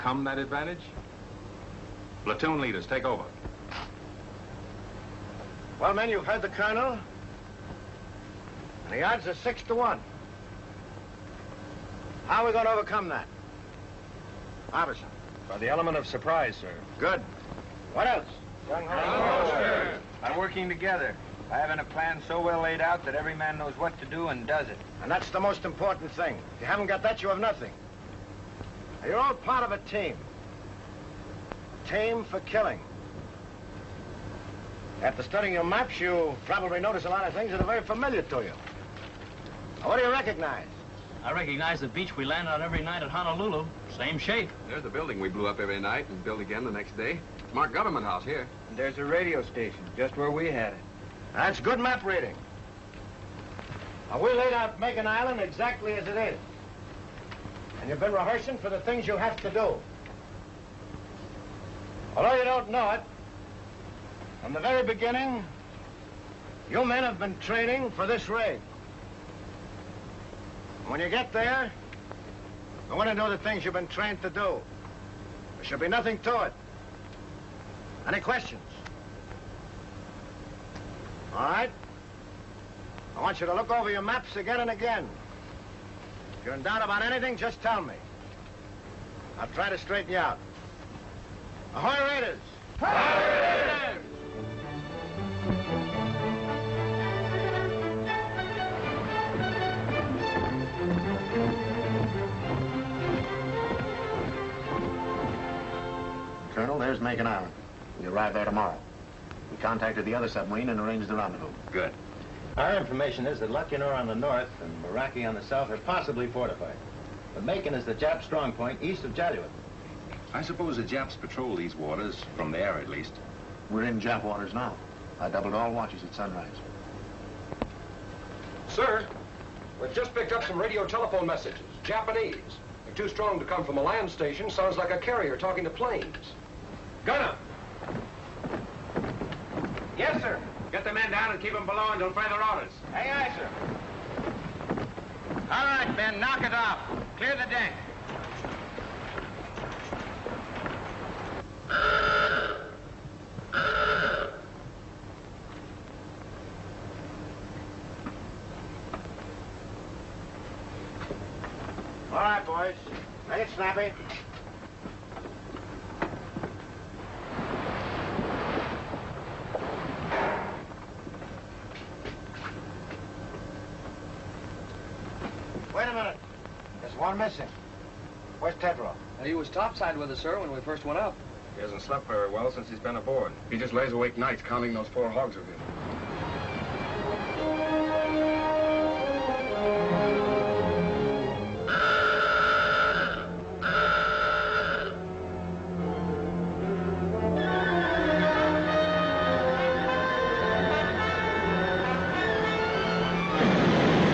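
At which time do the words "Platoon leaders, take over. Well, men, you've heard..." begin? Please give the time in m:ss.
0:02.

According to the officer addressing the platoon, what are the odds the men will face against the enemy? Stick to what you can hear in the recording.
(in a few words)
6 to 1.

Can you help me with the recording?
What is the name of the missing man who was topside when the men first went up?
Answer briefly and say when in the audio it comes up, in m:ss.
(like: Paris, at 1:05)
Tedrow, at 2:58.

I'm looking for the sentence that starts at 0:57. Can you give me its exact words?
And you've been rehearsing for the things you have to do.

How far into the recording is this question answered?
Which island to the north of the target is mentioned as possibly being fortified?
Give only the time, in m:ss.
1:53.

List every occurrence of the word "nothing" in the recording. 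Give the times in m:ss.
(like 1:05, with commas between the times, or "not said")
0:27, 1:15.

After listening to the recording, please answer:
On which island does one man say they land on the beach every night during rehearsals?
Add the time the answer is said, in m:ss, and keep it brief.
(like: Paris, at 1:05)
Honolulu, at 0:43.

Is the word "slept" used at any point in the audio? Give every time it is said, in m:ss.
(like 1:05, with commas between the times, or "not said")
3:01.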